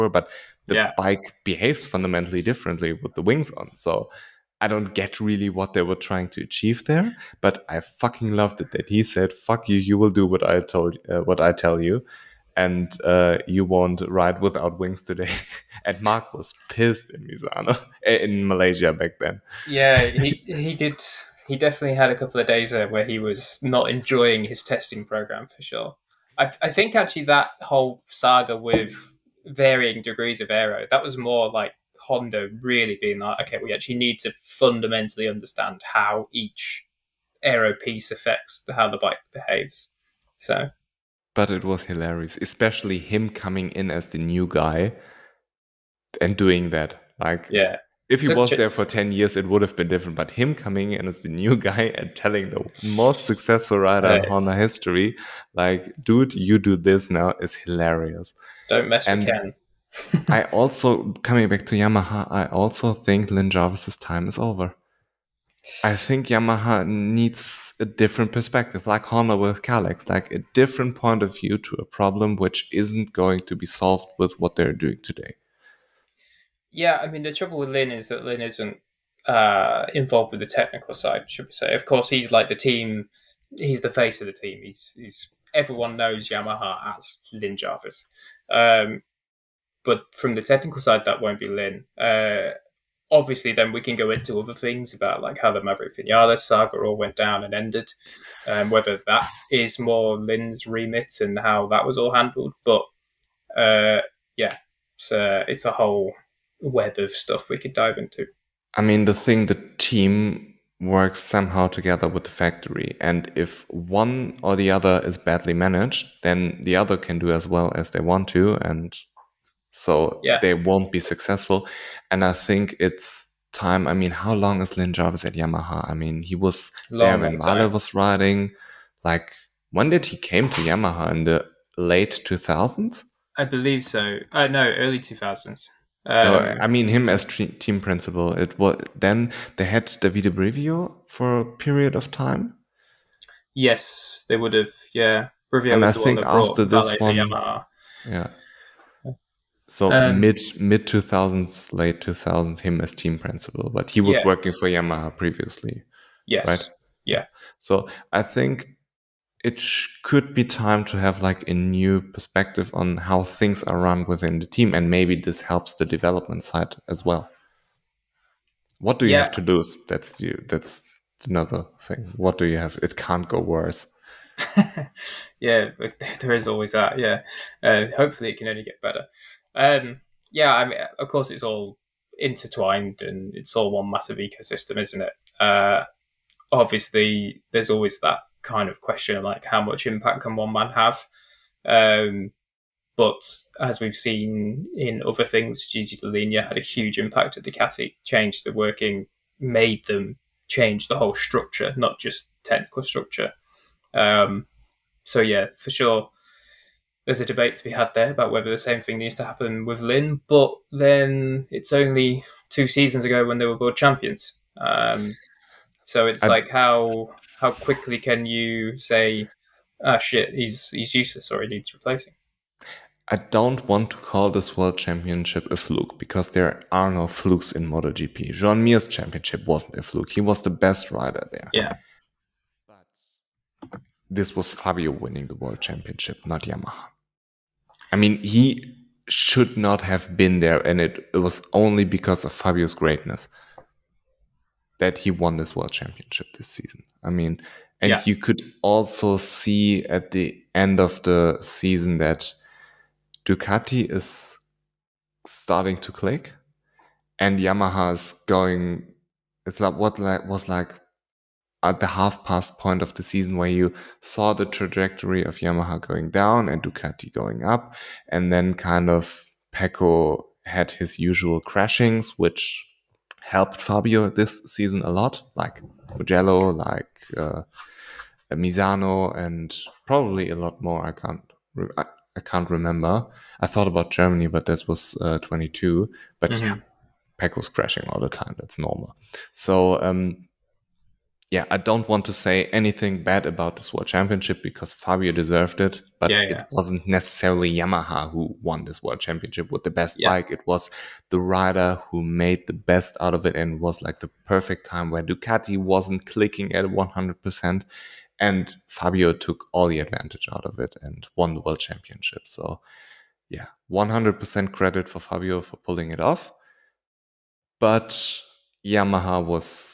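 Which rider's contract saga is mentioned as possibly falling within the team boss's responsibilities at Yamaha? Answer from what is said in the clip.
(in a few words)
Maverick Vinales.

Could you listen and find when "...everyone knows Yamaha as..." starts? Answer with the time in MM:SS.
01:25.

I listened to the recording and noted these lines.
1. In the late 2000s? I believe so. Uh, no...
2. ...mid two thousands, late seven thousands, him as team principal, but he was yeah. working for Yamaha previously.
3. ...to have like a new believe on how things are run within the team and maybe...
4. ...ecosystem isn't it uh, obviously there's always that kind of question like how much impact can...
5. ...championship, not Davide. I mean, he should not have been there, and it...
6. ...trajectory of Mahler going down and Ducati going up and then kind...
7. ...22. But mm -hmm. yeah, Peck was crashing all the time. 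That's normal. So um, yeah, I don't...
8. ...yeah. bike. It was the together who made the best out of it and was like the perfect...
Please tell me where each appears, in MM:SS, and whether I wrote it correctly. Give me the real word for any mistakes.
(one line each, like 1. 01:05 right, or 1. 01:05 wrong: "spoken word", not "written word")
1. 02:11 right
2. 02:30 wrong: "two", not "seven"
3. 02:40 wrong: "perspective", not "believe"
4. 03:04 right
5. 03:55 wrong: "Yamaha", not "Davide"
6. 04:24 wrong: "Yamaha", not "Mahler"
7. 04:45 right
8. 04:59 wrong: "rider", not "together".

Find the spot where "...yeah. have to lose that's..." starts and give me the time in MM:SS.
02:49.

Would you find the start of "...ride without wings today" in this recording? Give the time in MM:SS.
00:14.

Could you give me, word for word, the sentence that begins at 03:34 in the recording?
Um, so it's I, like how how quickly can you say, ah, shit, he's he's useless or he needs replacing?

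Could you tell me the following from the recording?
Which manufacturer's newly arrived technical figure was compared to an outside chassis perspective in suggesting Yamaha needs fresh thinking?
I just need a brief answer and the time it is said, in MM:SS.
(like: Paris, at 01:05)
Kalex, at 01:09.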